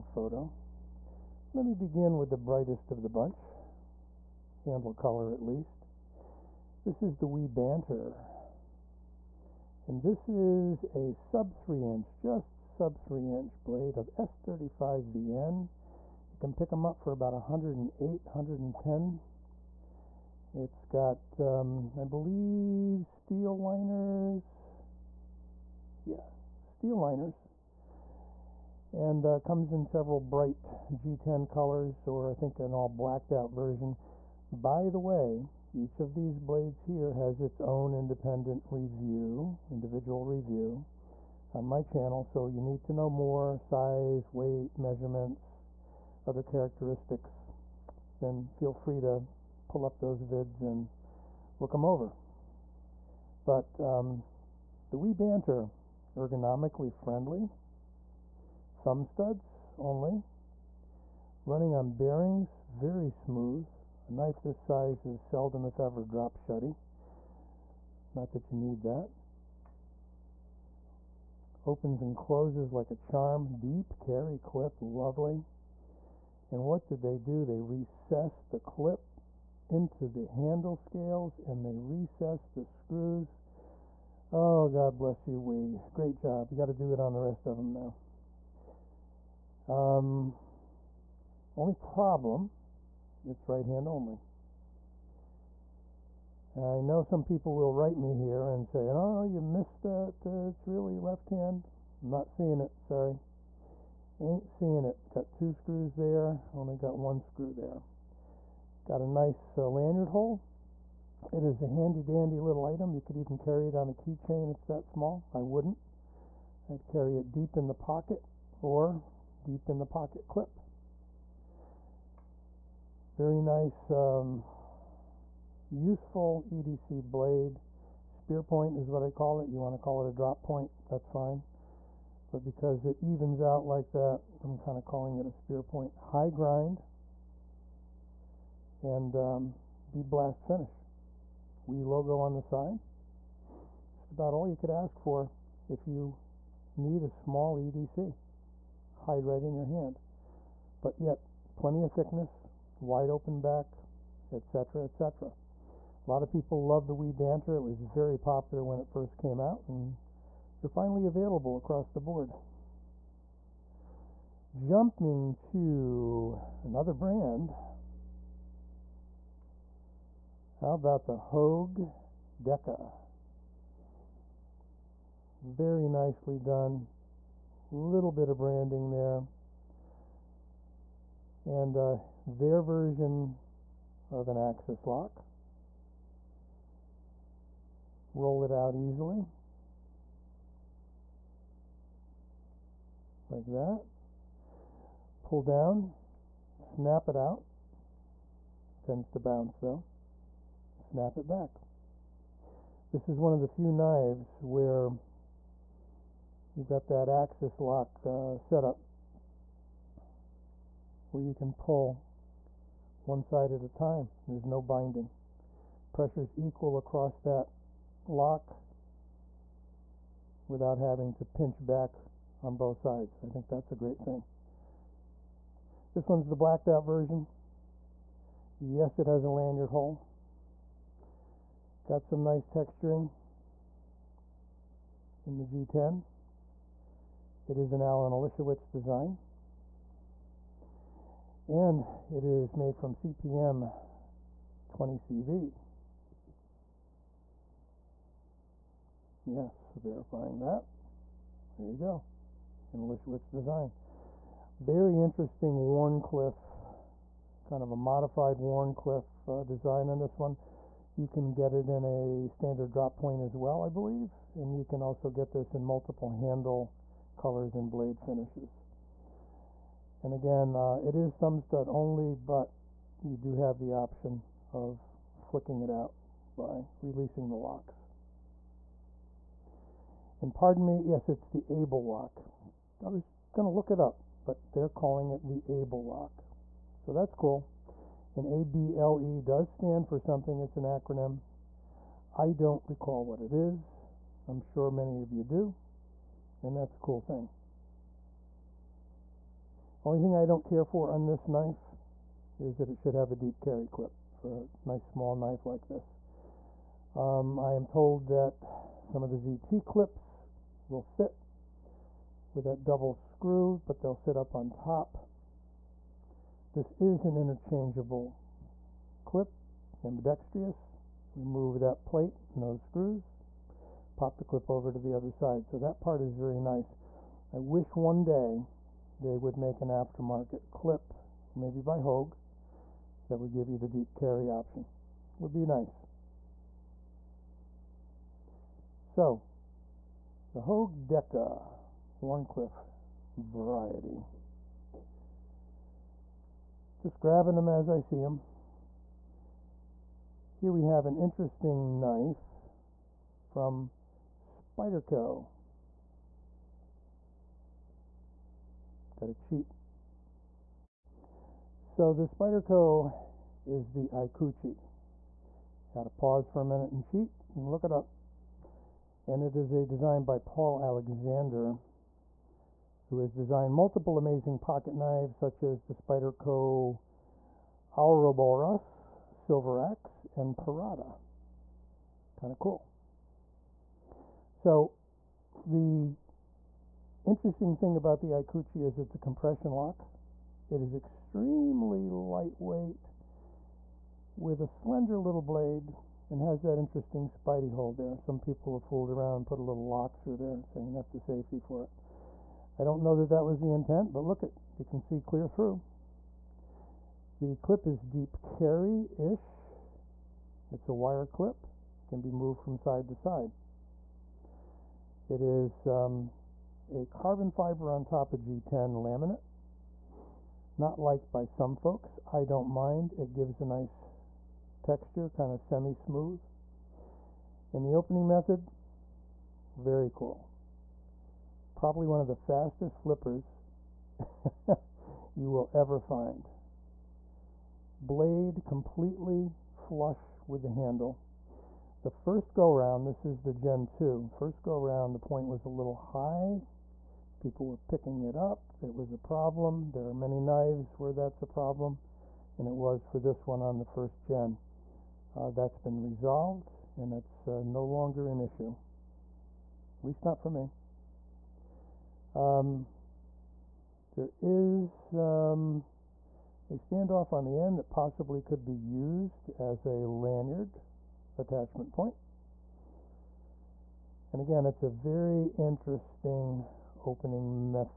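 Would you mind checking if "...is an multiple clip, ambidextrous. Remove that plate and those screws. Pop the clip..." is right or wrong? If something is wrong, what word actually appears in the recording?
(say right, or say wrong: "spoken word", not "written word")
wrong: "interchangeable", not "multiple".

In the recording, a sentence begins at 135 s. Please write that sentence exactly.
High grind and um, bead blast finish.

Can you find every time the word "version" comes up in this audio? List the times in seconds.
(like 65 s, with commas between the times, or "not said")
33 s, 182 s, 226 s.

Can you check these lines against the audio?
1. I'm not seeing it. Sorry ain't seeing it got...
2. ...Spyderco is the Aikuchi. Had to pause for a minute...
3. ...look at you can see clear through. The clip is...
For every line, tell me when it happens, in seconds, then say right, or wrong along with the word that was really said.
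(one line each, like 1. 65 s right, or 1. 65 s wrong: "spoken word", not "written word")
1. 102 s right
2. 362 s right
3. 404 s right.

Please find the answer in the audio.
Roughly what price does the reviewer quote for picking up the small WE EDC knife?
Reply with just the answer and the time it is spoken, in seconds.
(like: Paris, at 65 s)
108, at 17 s.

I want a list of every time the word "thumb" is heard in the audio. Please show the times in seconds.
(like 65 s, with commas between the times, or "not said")
58 s, 271 s.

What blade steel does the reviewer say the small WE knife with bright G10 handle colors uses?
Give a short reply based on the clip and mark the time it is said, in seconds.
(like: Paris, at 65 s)
S35VN, at 14 s.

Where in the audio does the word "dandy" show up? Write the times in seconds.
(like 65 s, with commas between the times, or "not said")
112 s.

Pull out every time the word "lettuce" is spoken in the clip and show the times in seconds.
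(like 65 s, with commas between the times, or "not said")
not said.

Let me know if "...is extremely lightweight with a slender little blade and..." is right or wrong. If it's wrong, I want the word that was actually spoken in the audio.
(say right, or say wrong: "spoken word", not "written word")
right.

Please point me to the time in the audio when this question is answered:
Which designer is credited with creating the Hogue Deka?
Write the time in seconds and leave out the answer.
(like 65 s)
237 s.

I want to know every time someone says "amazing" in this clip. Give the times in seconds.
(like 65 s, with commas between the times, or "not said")
373 s.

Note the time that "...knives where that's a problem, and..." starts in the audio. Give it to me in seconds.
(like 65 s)
450 s.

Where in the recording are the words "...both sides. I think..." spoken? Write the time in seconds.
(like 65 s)
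222 s.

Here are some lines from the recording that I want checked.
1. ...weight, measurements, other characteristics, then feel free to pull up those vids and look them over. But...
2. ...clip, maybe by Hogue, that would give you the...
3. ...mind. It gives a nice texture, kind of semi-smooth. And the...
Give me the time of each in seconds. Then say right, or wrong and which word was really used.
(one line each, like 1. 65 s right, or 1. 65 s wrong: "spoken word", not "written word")
1. 44 s right
2. 330 s right
3. 422 s right.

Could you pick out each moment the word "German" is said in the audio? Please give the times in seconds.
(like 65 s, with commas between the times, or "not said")
not said.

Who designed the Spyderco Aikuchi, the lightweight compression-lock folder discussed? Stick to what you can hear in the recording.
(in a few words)
Paul Alexander.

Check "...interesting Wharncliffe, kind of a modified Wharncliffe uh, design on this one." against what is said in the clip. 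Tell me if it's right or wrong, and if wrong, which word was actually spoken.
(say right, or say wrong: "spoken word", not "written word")
right.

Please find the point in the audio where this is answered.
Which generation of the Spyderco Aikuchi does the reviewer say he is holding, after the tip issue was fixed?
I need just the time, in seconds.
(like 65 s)
443 s.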